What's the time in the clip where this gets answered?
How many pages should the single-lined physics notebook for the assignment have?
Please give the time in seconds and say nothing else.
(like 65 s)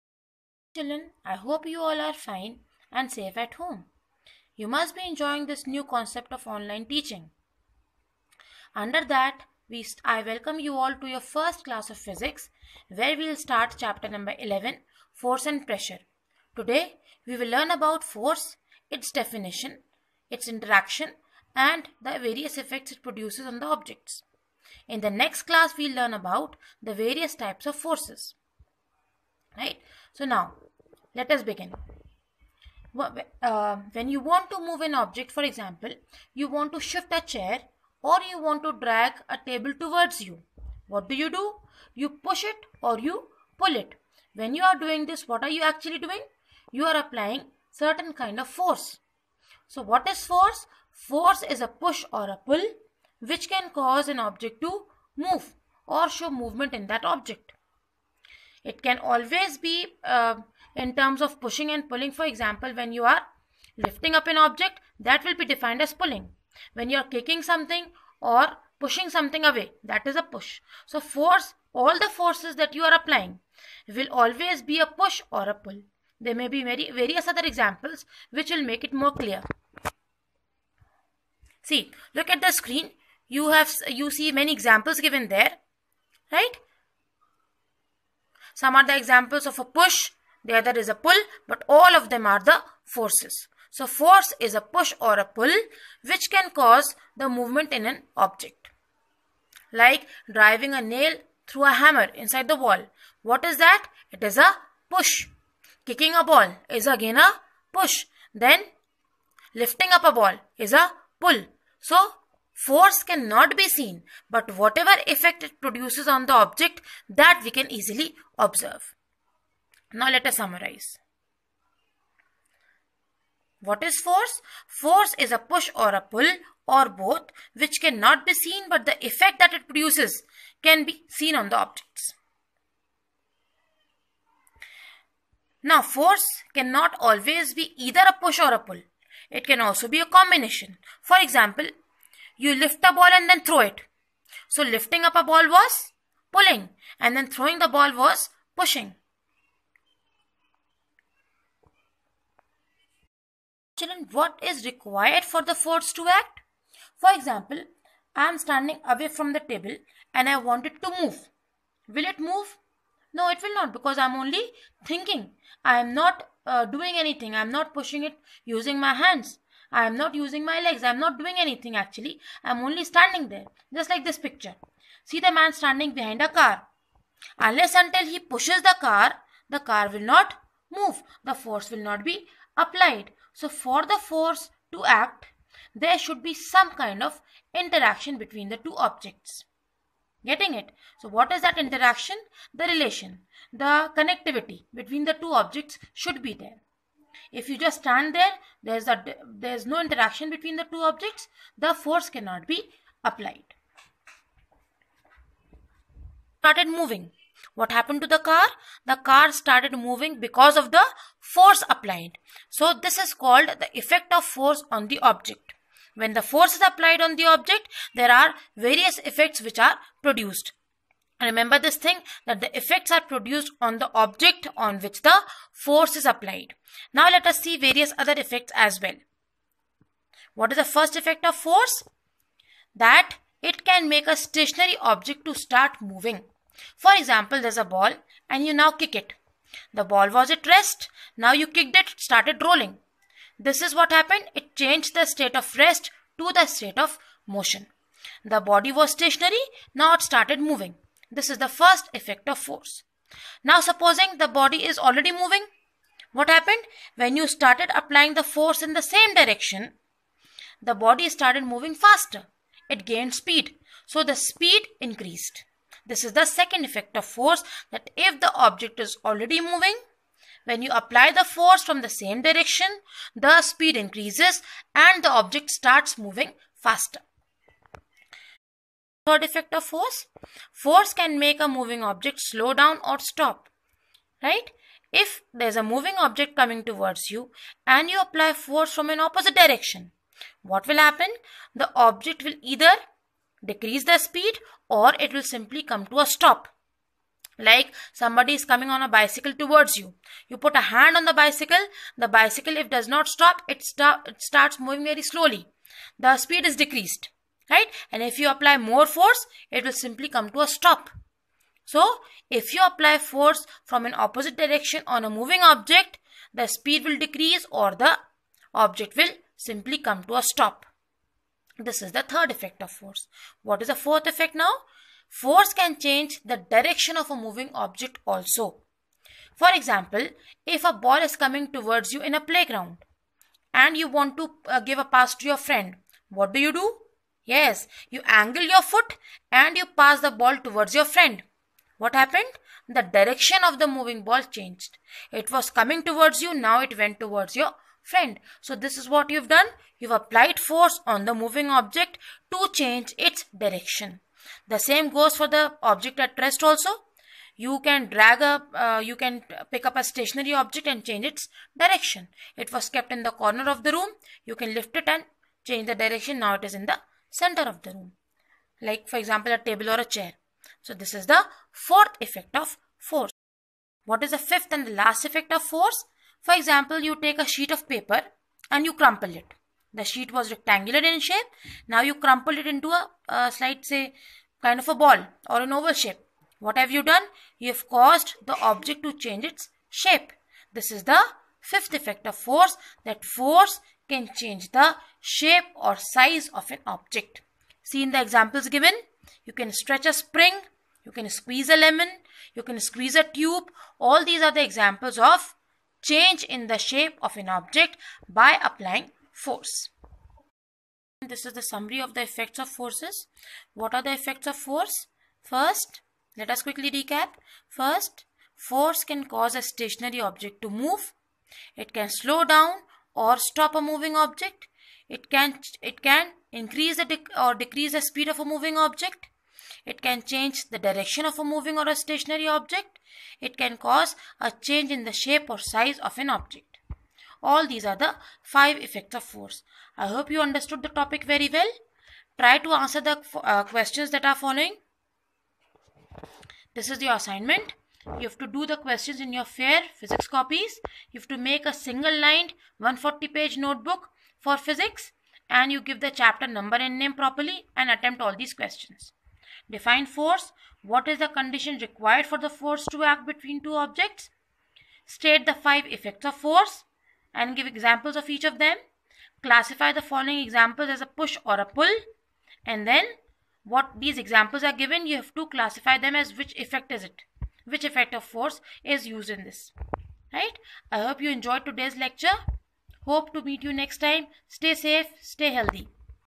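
452 s.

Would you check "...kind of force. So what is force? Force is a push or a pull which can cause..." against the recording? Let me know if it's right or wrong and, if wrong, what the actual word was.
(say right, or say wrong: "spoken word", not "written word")
right.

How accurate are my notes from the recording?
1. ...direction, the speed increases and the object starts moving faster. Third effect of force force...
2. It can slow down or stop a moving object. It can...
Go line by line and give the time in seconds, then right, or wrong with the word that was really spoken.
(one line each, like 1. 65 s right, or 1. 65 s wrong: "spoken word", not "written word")
1. 272 s right
2. 421 s right.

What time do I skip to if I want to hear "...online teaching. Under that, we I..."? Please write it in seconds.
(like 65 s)
6 s.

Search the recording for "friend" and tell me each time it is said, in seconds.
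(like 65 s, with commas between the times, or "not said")
335 s, 340 s, 347 s.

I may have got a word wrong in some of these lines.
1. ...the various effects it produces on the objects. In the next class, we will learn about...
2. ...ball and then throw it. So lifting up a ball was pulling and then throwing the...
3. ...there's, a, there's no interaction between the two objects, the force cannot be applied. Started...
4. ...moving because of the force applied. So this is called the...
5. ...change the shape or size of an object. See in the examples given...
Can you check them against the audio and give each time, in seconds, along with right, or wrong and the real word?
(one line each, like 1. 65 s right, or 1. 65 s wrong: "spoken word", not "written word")
1. 22 s right
2. 142 s right
3. 198 s right
4. 209 s right
5. 394 s right.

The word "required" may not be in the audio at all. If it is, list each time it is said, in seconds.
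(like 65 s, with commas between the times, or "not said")
154 s, 461 s.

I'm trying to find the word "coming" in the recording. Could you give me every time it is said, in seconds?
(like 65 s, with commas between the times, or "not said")
286 s, 298 s, 331 s, 345 s.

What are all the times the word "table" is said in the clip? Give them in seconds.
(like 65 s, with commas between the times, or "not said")
39 s, 159 s, 369 s.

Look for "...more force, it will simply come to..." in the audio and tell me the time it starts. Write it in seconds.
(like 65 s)
308 s.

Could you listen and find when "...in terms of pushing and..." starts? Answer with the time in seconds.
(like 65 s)
60 s.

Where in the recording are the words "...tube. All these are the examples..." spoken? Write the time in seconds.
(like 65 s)
403 s.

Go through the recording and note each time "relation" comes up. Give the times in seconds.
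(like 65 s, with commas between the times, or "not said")
192 s.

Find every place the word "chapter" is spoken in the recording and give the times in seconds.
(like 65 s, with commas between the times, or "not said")
13 s, 455 s.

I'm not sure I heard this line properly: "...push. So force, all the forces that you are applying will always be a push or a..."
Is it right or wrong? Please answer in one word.
right.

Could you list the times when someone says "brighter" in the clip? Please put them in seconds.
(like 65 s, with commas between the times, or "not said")
not said.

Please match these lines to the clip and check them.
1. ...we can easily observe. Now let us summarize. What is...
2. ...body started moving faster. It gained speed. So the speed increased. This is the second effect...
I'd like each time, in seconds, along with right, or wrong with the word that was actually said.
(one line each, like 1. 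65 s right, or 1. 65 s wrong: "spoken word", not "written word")
1. 117 s right
2. 260 s right.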